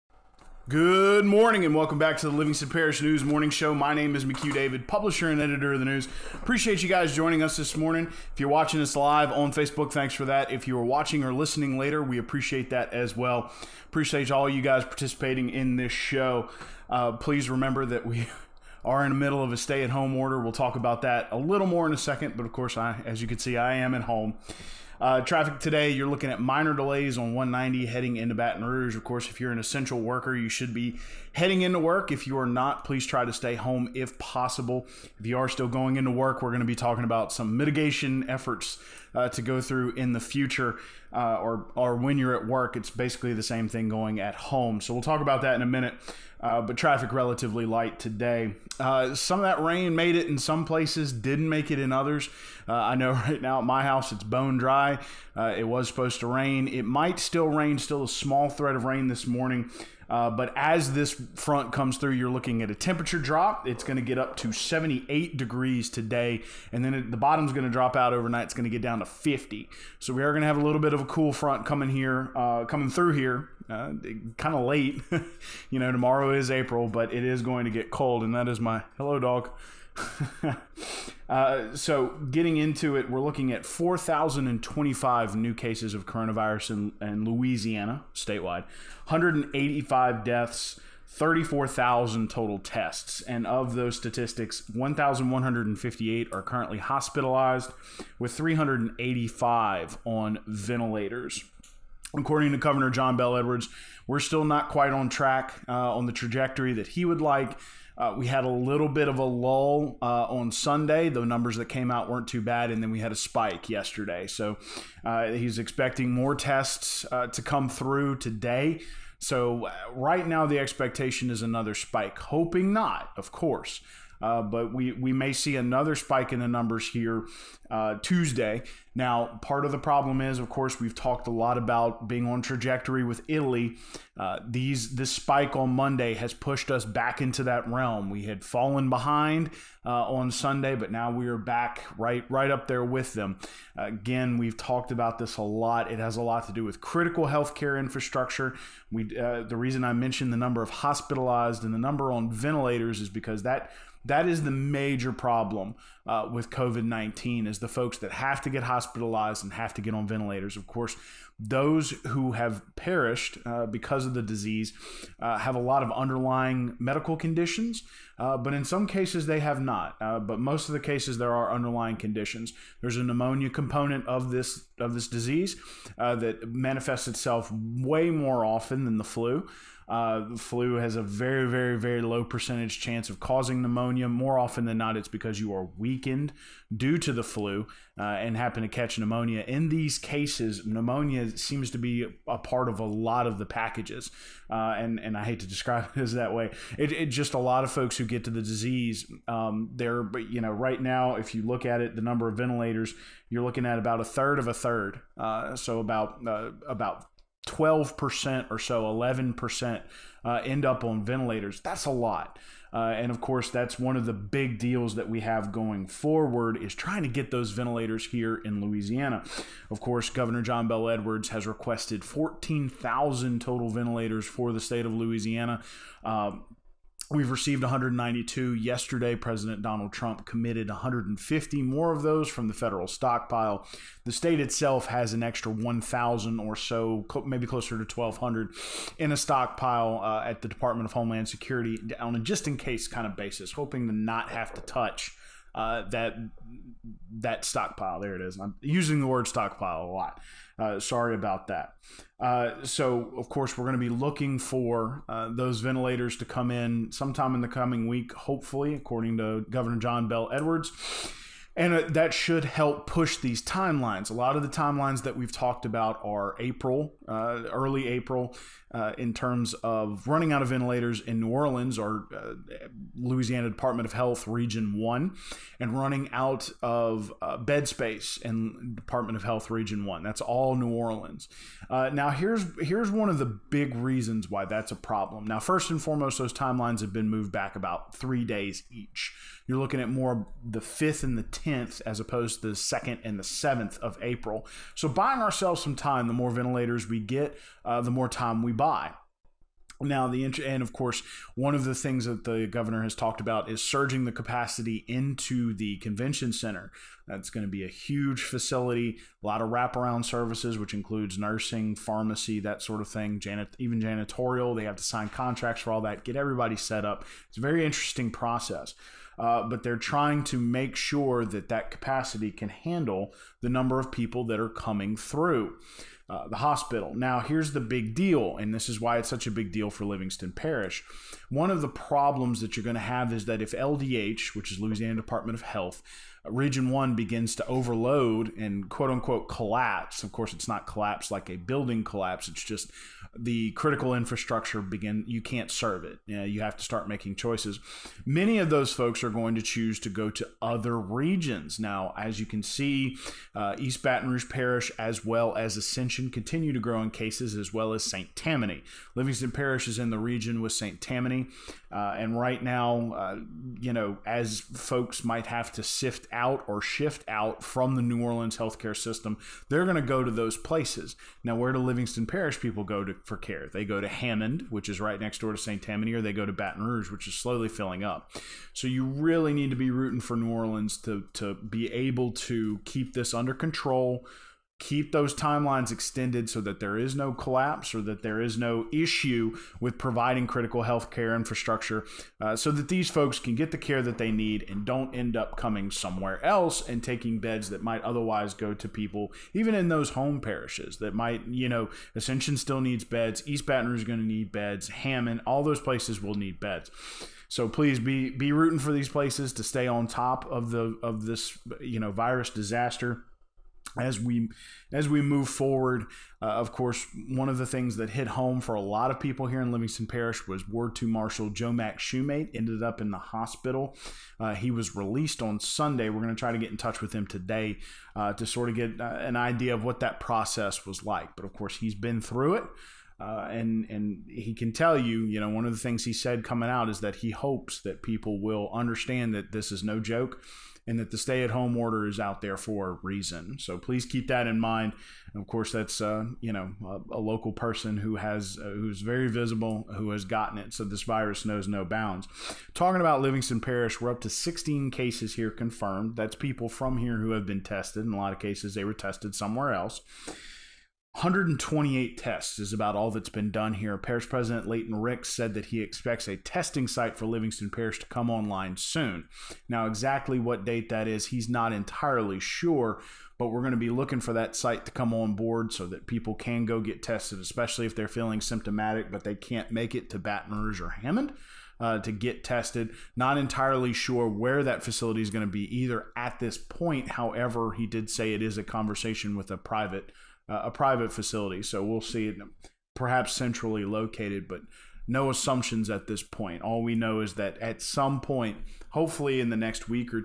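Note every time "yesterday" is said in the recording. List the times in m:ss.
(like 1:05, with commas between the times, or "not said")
1:53, 3:48.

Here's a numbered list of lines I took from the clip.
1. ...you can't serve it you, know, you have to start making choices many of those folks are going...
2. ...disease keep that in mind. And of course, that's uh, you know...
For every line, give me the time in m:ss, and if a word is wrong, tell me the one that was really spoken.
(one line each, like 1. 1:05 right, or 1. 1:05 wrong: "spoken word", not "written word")
1. 5:45 right
2. 7:23 wrong: "please", not "disease".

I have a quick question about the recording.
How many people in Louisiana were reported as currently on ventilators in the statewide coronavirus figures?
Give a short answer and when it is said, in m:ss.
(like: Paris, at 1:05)
385, at 1:38.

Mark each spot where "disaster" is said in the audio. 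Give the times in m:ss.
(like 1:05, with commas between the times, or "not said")
6:52.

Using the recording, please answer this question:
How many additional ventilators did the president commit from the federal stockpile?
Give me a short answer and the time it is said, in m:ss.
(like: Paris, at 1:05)
150, at 3:50.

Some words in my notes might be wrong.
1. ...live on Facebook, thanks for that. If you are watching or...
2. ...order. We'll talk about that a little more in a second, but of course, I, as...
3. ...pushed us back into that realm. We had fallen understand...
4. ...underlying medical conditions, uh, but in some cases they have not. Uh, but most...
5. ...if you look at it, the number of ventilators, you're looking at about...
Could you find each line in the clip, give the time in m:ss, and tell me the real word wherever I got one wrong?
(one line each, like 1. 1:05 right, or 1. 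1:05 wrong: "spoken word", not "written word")
1. 0:08 right
2. 0:20 right
3. 2:16 wrong: "behind", not "understand"
4. 2:45 right
5. 3:21 right.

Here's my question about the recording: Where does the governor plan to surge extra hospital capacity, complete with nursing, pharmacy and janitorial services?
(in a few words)
the convention center.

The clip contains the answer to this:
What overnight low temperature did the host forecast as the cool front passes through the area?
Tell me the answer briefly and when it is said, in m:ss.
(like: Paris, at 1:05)
50, at 1:09.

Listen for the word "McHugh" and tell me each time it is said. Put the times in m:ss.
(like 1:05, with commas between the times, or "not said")
0:04.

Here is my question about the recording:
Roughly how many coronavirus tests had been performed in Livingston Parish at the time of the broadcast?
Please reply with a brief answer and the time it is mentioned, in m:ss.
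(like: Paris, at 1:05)
128, at 7:40.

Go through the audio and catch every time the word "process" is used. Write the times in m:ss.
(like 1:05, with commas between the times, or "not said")
5:18, 7:10.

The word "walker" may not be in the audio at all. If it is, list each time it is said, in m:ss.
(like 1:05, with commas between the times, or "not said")
not said.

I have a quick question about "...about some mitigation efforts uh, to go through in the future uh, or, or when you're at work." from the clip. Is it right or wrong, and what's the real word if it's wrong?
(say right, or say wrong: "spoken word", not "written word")
right.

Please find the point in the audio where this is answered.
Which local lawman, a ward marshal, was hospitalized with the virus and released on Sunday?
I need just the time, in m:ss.
7:01.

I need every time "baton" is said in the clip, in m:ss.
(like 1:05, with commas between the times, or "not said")
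0:28, 5:53, 6:16, 6:43, 7:59.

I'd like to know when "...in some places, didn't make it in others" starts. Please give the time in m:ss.
0:50.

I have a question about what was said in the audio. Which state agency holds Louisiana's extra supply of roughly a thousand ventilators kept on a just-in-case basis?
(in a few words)
Department of Homeland Security.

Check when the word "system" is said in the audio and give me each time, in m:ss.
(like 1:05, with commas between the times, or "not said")
6:08.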